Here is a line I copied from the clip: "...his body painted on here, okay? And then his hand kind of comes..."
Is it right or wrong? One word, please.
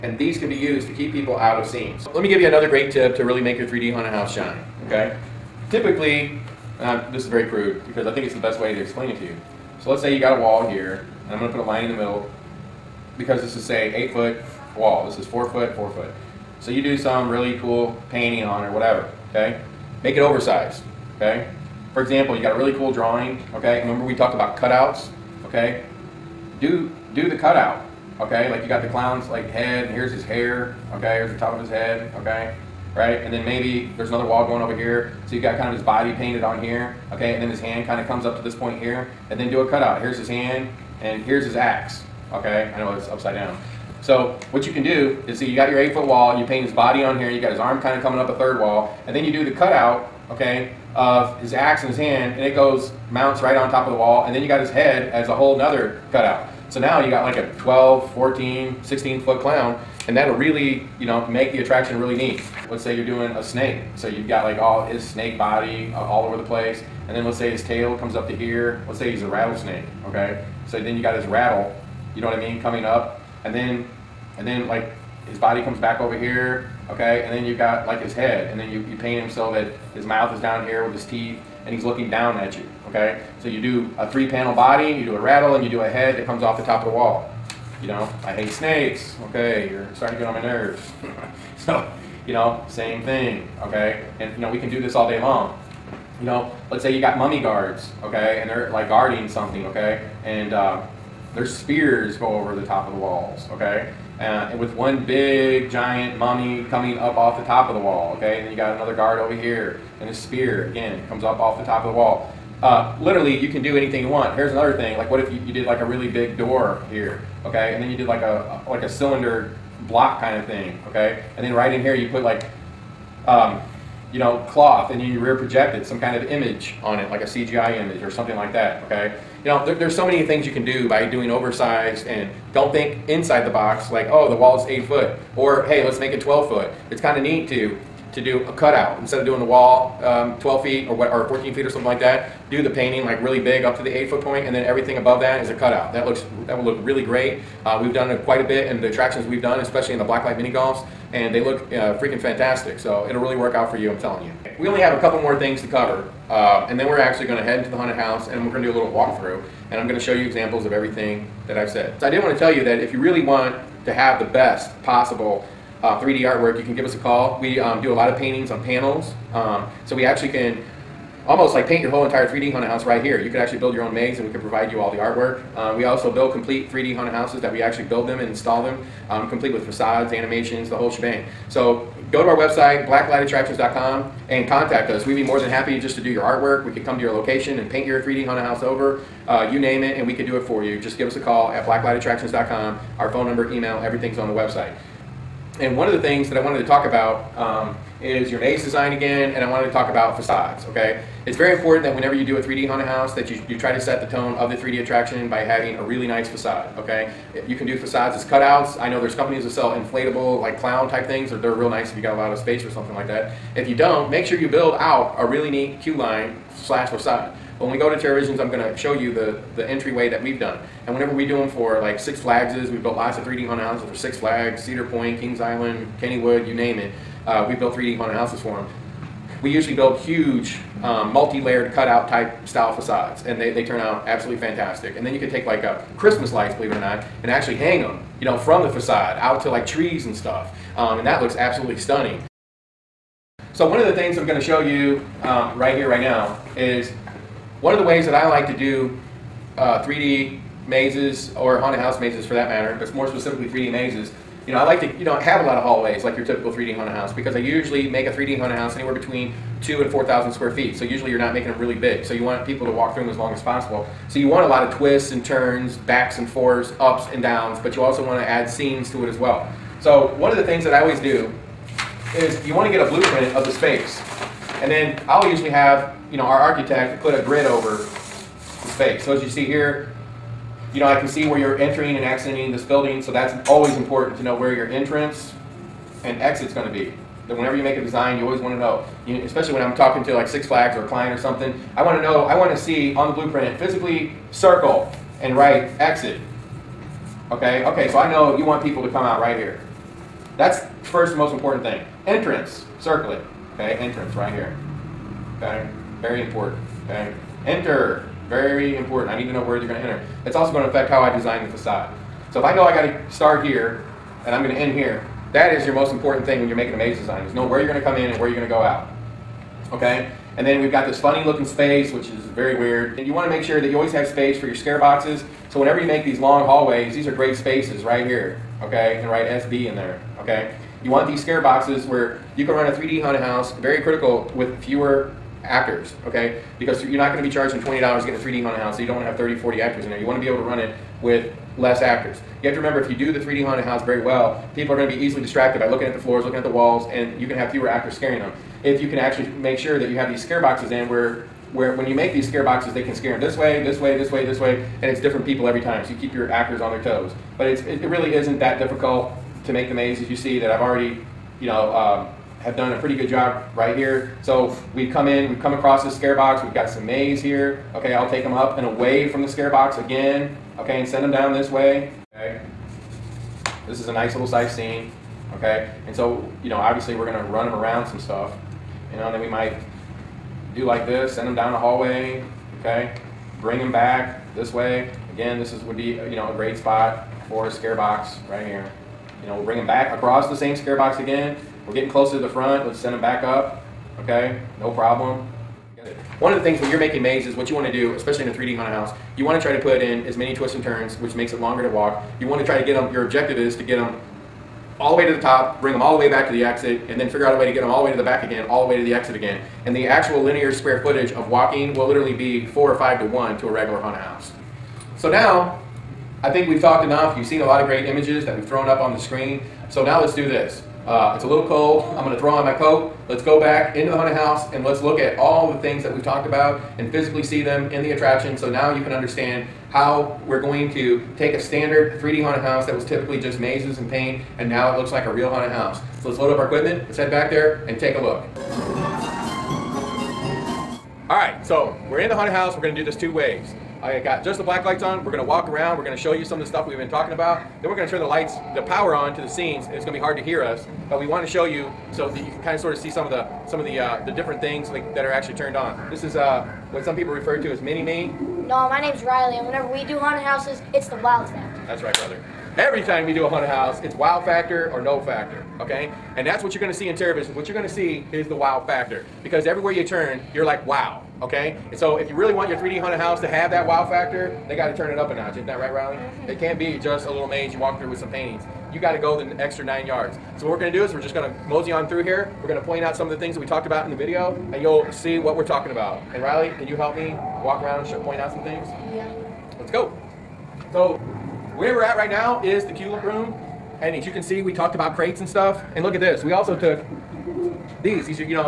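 right.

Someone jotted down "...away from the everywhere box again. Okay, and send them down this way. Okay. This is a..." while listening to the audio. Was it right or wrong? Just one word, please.
wrong.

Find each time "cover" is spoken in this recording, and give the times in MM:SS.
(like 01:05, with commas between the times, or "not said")
02:35.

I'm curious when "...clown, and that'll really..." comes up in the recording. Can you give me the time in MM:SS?
00:59.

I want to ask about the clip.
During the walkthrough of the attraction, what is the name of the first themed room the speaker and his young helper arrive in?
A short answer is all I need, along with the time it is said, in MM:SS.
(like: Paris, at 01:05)
tulip room, at 08:12.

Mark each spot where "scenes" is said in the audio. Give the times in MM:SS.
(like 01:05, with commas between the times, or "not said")
00:01, 04:28, 06:14, 07:29.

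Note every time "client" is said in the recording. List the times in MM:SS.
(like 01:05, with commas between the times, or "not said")
04:50.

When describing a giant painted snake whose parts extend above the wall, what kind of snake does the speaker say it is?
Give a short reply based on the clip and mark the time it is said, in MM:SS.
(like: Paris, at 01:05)
rattlesnake, at 01:09.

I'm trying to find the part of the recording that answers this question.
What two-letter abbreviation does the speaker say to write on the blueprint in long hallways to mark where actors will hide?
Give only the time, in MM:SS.
05:29.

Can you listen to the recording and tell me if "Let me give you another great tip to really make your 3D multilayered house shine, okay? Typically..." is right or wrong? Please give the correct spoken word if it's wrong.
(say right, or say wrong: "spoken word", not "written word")
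wrong: "haunted", not "multilayered".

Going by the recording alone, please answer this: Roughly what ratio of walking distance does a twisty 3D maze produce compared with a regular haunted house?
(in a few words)
4 or 5 to 1.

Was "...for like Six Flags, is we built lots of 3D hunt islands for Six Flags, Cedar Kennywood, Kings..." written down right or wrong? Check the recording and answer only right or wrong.
wrong.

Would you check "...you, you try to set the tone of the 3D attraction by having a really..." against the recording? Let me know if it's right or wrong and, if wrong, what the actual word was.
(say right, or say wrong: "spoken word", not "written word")
right.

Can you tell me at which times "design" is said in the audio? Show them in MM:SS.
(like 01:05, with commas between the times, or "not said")
03:18, 04:47, 05:11, 05:16.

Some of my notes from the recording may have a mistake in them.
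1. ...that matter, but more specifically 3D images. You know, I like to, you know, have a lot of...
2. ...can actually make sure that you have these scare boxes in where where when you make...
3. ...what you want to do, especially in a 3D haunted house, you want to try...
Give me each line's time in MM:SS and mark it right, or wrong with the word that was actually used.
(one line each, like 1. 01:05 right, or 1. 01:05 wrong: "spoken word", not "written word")
1. 04:12 wrong: "mazes", not "images"
2. 05:48 right
3. 06:37 right.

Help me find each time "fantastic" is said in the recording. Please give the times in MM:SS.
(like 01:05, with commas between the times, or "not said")
02:32, 03:54.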